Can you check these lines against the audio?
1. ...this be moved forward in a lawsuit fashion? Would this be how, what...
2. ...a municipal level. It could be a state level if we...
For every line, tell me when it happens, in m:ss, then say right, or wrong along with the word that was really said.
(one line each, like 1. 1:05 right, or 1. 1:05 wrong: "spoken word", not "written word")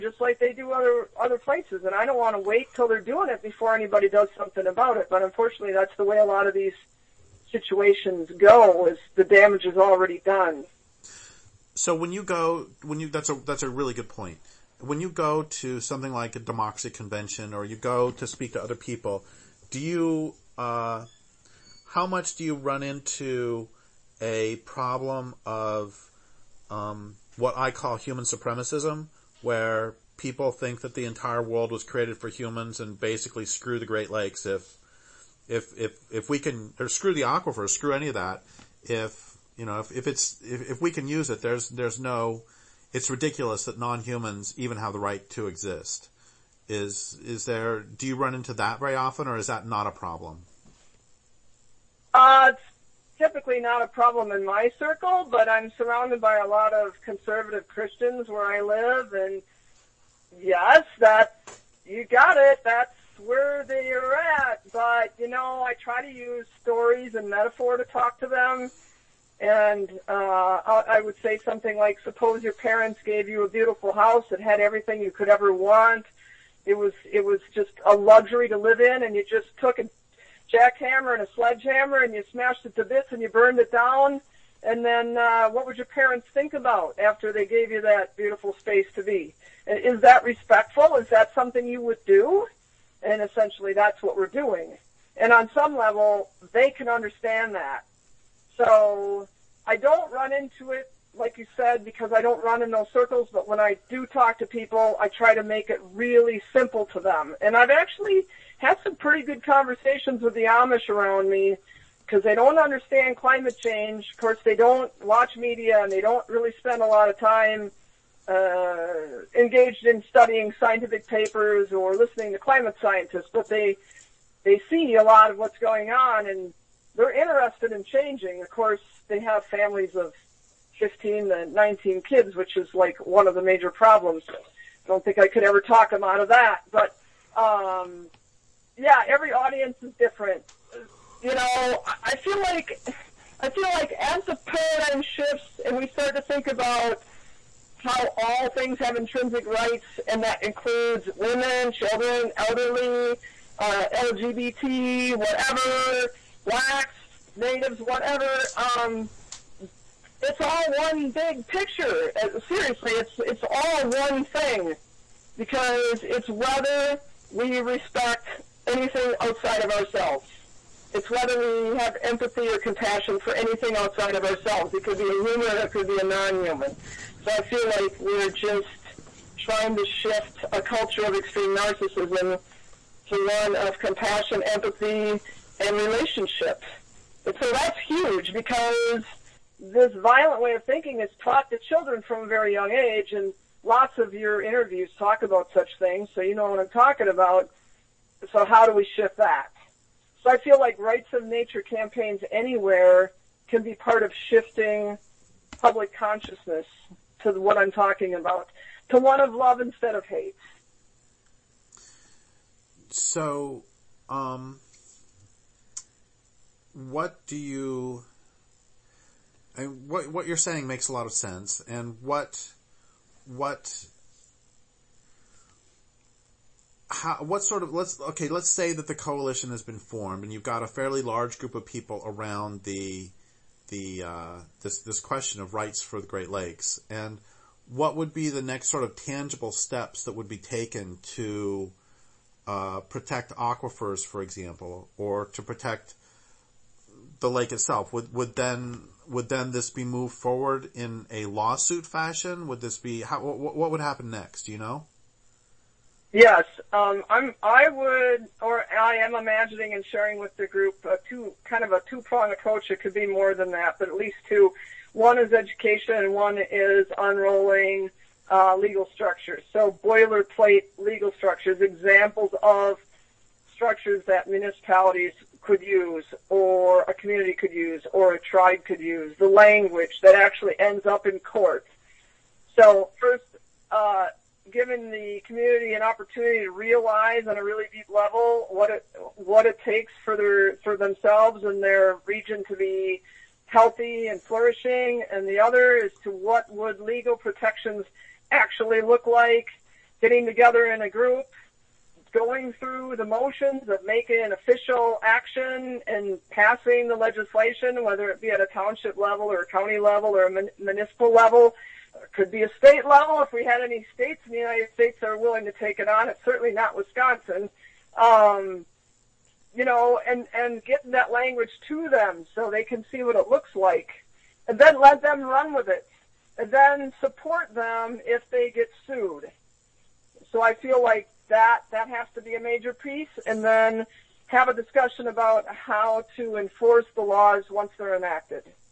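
1. 4:09 right
2. 5:10 right.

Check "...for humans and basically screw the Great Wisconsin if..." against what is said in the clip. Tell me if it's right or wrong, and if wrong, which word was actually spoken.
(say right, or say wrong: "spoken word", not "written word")
wrong: "Lakes", not "Wisconsin".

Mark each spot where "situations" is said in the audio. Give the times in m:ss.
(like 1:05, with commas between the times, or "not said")
0:07.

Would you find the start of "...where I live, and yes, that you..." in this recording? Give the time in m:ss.
0:58.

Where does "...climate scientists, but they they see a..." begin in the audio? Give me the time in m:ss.
2:02.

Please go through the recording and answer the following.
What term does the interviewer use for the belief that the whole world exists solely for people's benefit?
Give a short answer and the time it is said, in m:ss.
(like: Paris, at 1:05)
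Human supremacism, at 0:27.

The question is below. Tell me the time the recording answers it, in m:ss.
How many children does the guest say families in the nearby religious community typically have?
2:10.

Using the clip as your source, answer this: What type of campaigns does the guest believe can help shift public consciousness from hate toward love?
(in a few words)
Rights of nature campaigns.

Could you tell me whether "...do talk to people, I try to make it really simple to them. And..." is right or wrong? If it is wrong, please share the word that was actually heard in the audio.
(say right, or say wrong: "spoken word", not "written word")
right.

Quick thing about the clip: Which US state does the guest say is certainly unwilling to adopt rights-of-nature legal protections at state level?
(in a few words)
Wisconsin.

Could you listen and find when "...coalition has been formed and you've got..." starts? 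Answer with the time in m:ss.
3:48.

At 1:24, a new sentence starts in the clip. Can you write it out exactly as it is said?
And then, uh, what would your parents think about after they gave you that beautiful space to be?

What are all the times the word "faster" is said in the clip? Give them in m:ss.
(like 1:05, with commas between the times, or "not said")
not said.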